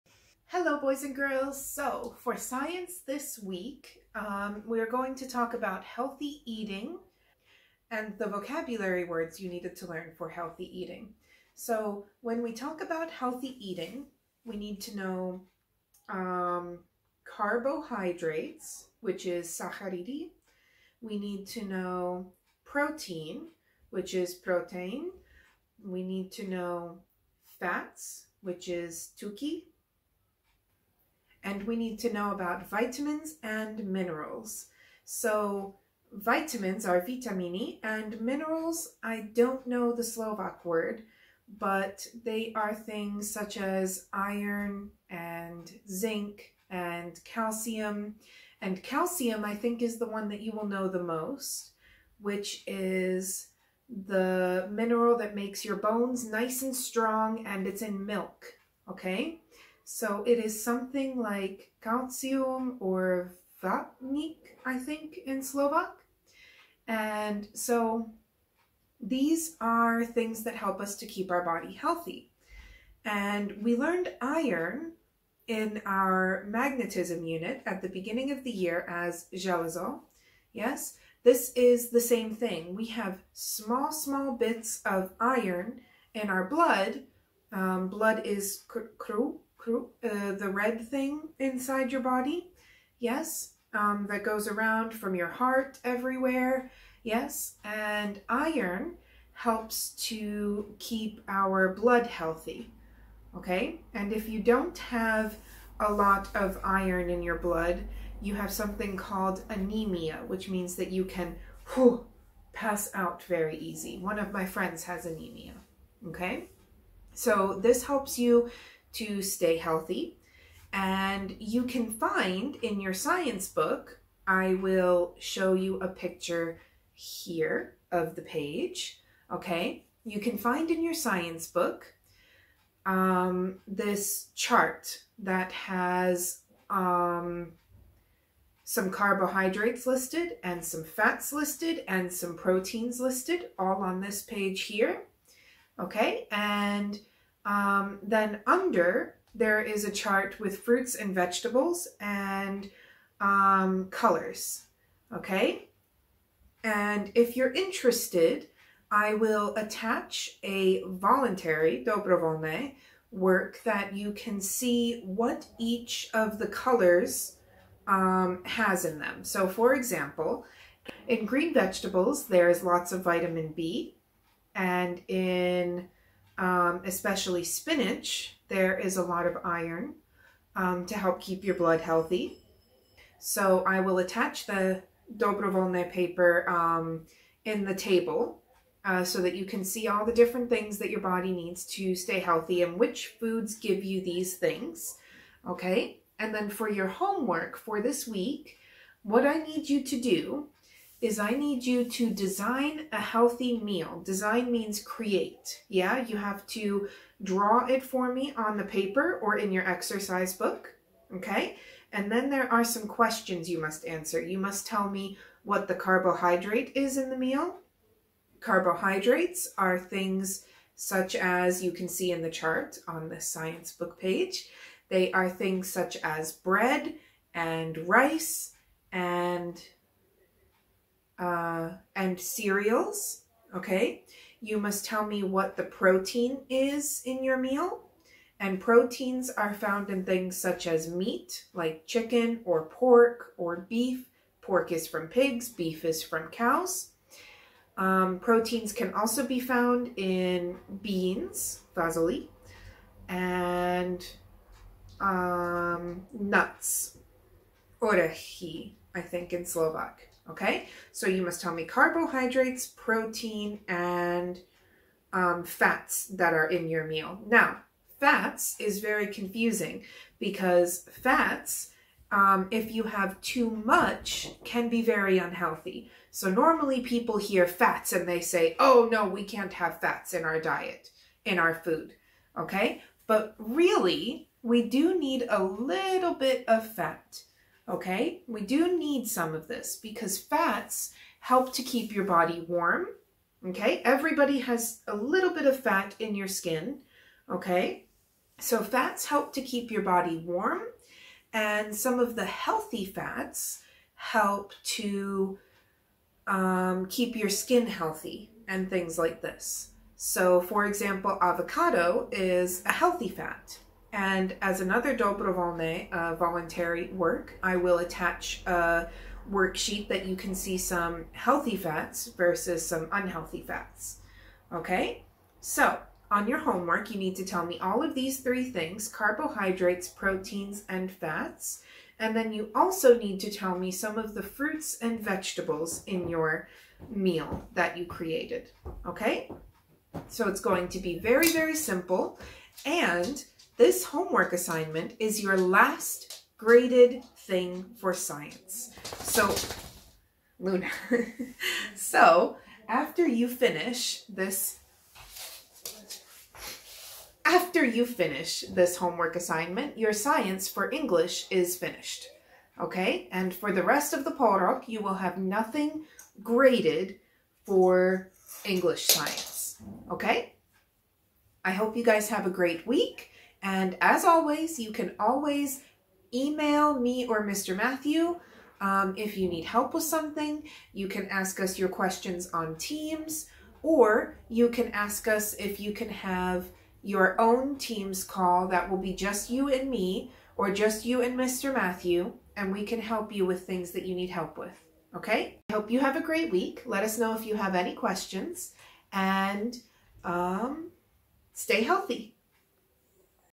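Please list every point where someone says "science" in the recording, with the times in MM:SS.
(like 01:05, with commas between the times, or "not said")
00:02, 02:02, 02:10, 03:43, 05:47, 05:59, 06:08.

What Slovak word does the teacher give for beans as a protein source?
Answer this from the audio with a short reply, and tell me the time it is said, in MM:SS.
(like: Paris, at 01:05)
vasoli, at 04:11.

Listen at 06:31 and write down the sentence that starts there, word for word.
Matthew, and we can help you with things that you need help with.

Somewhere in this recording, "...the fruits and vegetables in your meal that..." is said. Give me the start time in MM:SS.
05:34.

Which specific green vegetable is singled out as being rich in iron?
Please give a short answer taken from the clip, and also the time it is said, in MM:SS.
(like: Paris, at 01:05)
spinach, at 02:57.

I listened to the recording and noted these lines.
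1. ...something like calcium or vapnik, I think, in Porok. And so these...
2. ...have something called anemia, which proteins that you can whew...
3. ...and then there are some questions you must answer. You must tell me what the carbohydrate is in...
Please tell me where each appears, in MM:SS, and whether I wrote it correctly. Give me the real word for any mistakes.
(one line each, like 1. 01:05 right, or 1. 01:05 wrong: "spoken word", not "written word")
1. 01:00 wrong: "Slovak", not "Porok"
2. 01:48 wrong: "means", not "proteins"
3. 03:31 right.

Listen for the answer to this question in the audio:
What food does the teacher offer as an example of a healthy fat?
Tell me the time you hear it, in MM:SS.
05:11.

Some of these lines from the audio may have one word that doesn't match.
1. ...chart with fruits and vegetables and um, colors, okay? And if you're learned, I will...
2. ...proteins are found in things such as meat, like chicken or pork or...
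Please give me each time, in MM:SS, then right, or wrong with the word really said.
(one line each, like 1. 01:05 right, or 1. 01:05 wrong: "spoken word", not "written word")
1. 02:29 wrong: "interested", not "learned"
2. 03:58 right.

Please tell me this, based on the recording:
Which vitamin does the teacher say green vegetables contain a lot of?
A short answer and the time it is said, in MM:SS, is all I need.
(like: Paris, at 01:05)
vitamin B, at 02:53.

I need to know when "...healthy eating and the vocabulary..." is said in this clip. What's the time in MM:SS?
00:05.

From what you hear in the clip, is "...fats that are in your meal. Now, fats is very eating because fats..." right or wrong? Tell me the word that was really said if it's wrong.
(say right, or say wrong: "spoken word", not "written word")
wrong: "confusing", not "eating".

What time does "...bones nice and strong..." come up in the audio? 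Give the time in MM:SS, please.
00:55.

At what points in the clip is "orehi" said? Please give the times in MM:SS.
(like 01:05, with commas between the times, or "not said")
04:17.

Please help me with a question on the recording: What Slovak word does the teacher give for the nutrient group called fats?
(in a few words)
tuki.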